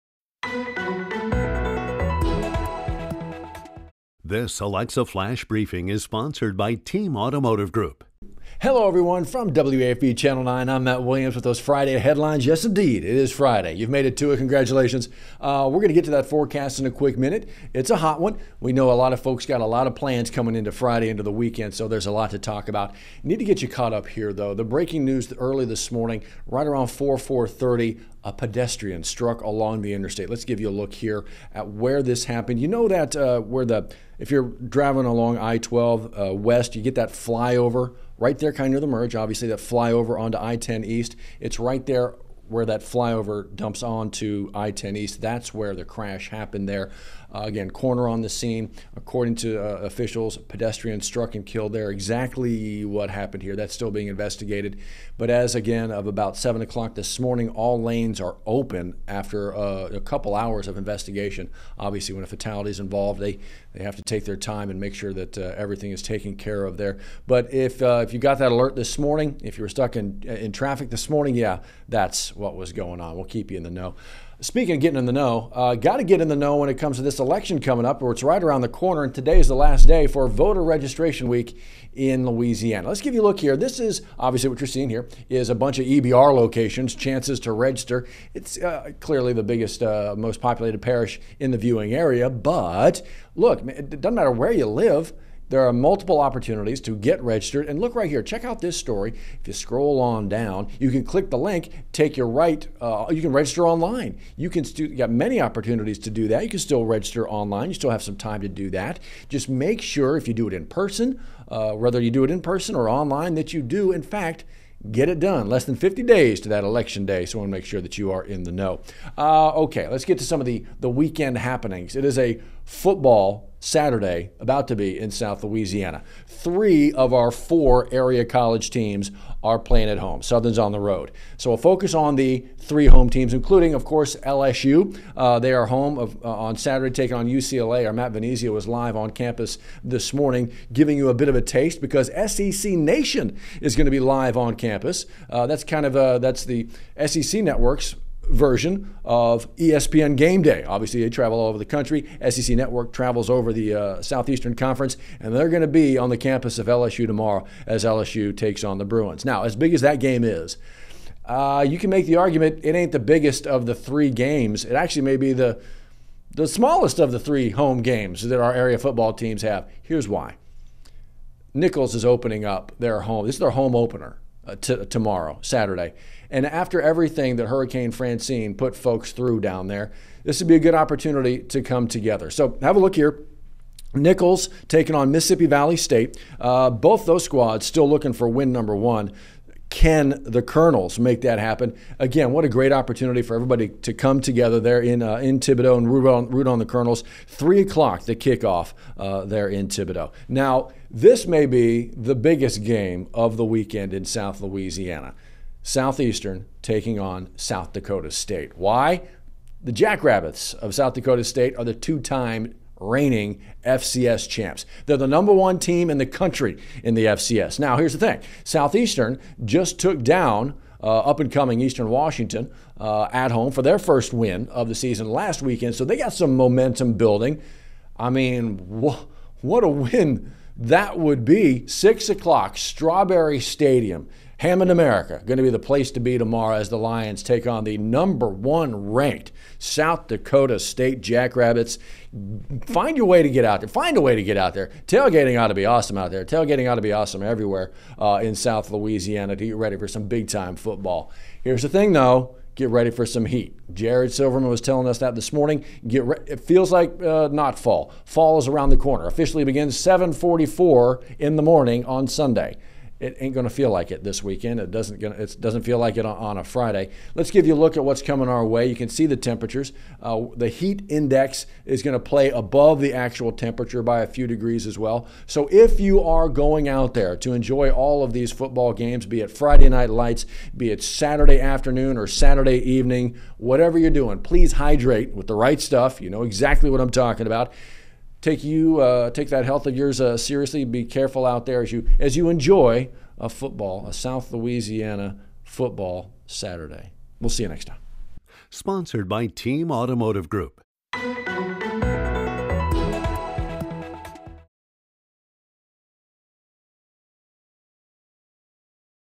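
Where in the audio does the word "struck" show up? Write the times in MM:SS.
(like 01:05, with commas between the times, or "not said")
00:29, 00:51.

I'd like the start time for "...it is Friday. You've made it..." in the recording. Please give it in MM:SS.
00:13.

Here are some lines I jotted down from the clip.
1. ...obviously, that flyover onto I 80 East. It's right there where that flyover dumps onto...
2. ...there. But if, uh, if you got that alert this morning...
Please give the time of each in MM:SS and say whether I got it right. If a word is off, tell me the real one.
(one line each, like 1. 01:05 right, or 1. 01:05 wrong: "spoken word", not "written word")
1. 00:39 wrong: "10", not "80"
2. 01:06 right.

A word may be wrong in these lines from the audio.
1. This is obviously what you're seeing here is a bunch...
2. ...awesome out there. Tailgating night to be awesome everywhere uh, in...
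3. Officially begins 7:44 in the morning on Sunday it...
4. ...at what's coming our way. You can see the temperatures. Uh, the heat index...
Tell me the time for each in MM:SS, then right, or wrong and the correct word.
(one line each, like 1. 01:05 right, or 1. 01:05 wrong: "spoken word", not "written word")
1. 01:23 right
2. 04:05 wrong: "ought", not "night"
3. 04:19 right
4. 04:27 right.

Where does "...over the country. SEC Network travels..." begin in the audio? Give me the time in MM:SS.
02:31.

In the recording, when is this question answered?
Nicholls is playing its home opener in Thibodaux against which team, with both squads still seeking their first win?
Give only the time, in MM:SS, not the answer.
03:05.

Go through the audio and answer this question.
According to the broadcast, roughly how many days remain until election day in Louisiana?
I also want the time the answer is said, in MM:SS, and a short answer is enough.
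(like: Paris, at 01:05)
Less than 50, at 01:55.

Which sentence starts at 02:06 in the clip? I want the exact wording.
Three of our four area college teams are playing at home.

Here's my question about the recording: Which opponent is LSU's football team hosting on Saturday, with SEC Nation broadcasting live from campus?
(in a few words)
UCLA.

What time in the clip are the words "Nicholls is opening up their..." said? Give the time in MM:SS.
02:51.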